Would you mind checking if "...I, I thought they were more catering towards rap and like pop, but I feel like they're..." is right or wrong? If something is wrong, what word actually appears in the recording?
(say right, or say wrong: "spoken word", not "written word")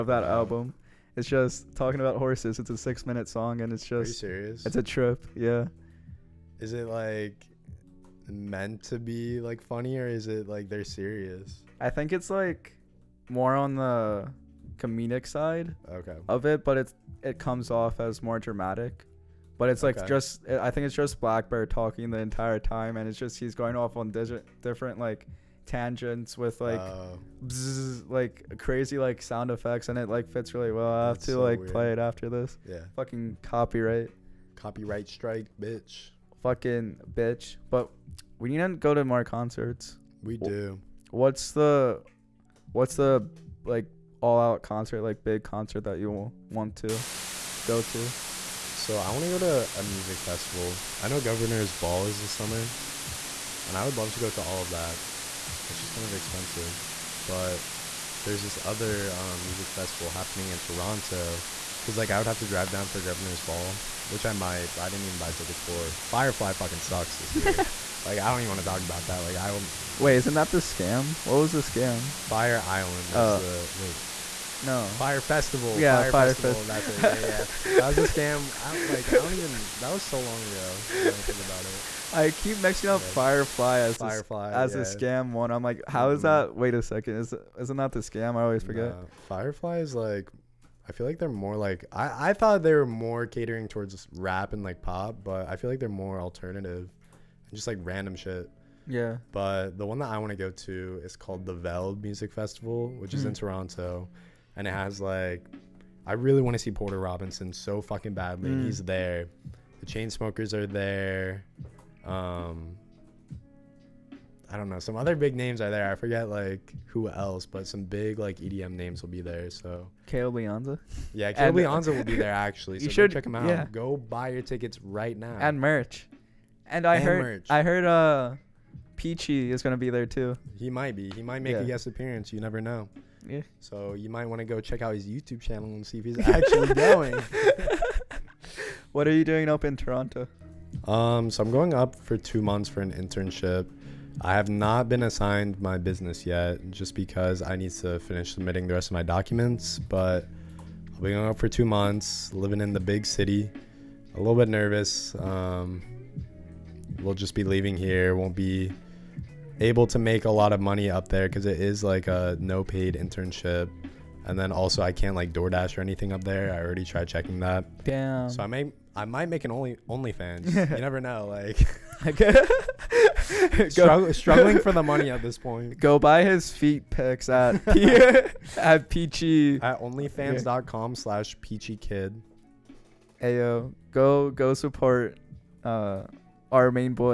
right.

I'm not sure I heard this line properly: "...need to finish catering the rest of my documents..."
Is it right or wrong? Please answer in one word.
wrong.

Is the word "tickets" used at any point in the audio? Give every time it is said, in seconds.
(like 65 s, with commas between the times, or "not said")
65 s, 124 s.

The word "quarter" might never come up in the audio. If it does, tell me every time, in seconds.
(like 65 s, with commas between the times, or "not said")
not said.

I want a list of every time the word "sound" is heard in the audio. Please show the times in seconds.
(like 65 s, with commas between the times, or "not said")
29 s.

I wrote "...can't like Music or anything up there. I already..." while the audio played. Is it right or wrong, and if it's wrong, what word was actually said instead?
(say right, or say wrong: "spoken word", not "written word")
wrong: "DoorDash", not "Music".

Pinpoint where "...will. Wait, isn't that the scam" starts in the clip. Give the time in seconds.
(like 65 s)
69 s.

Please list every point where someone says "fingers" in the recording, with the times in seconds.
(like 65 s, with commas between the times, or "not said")
not said.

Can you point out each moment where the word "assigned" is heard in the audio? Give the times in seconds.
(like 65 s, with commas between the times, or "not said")
145 s.